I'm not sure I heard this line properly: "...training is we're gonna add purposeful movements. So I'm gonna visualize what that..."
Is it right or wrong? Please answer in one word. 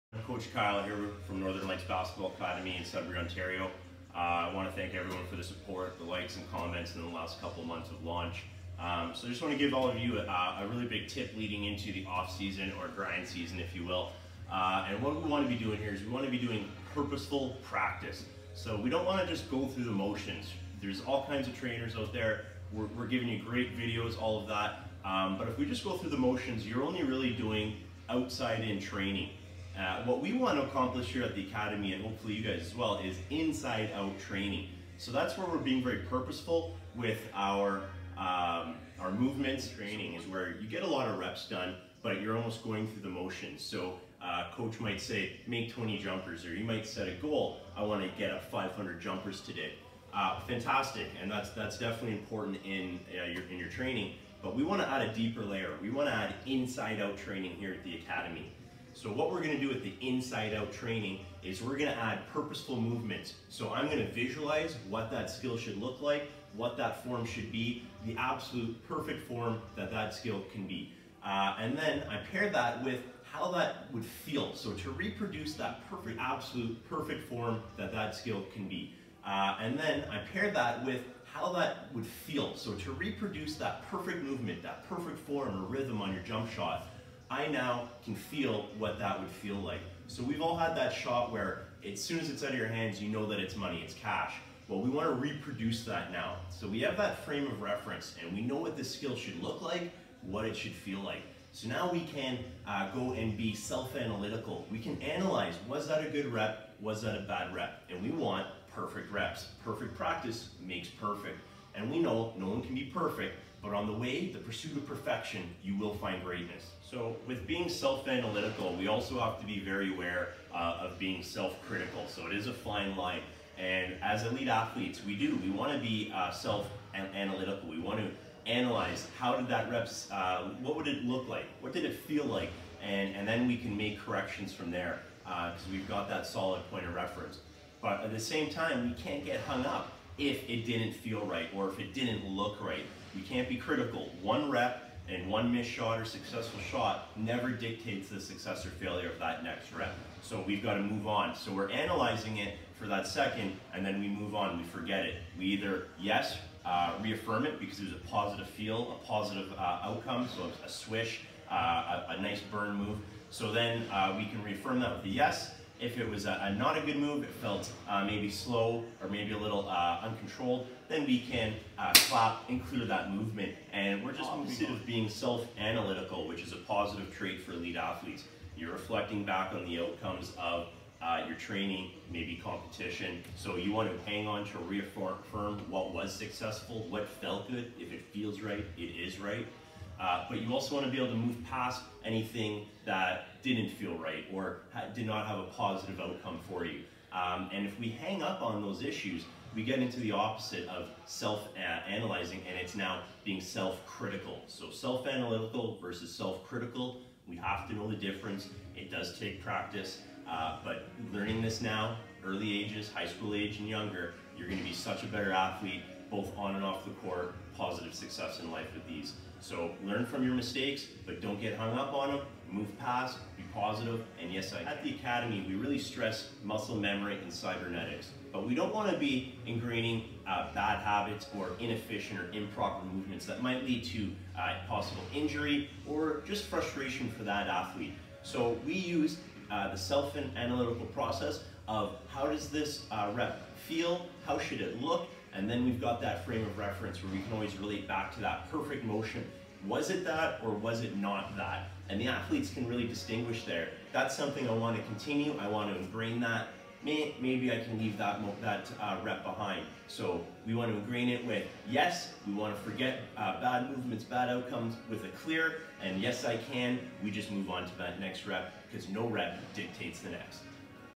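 right.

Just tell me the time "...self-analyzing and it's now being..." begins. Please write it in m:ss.
3:21.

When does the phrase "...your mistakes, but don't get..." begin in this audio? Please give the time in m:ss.
3:40.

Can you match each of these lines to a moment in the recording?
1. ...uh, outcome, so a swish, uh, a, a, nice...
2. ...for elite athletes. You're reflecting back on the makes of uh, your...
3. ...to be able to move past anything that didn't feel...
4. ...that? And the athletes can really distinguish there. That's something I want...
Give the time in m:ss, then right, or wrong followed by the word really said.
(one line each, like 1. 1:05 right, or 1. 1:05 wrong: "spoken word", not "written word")
1. 2:39 right
2. 2:57 wrong: "outcomes", not "makes"
3. 3:10 right
4. 4:11 right.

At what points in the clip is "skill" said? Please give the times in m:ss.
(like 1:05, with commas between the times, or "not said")
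1:05, 1:10, 1:18, 1:38.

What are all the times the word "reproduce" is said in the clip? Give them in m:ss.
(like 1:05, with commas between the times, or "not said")
1:14, 1:22, 1:35.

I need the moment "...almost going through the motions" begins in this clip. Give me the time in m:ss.
0:42.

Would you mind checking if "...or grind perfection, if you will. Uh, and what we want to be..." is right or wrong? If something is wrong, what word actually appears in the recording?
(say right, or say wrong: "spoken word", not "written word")
wrong: "season", not "perfection".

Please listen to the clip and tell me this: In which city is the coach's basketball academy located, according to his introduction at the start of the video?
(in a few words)
Sudbury.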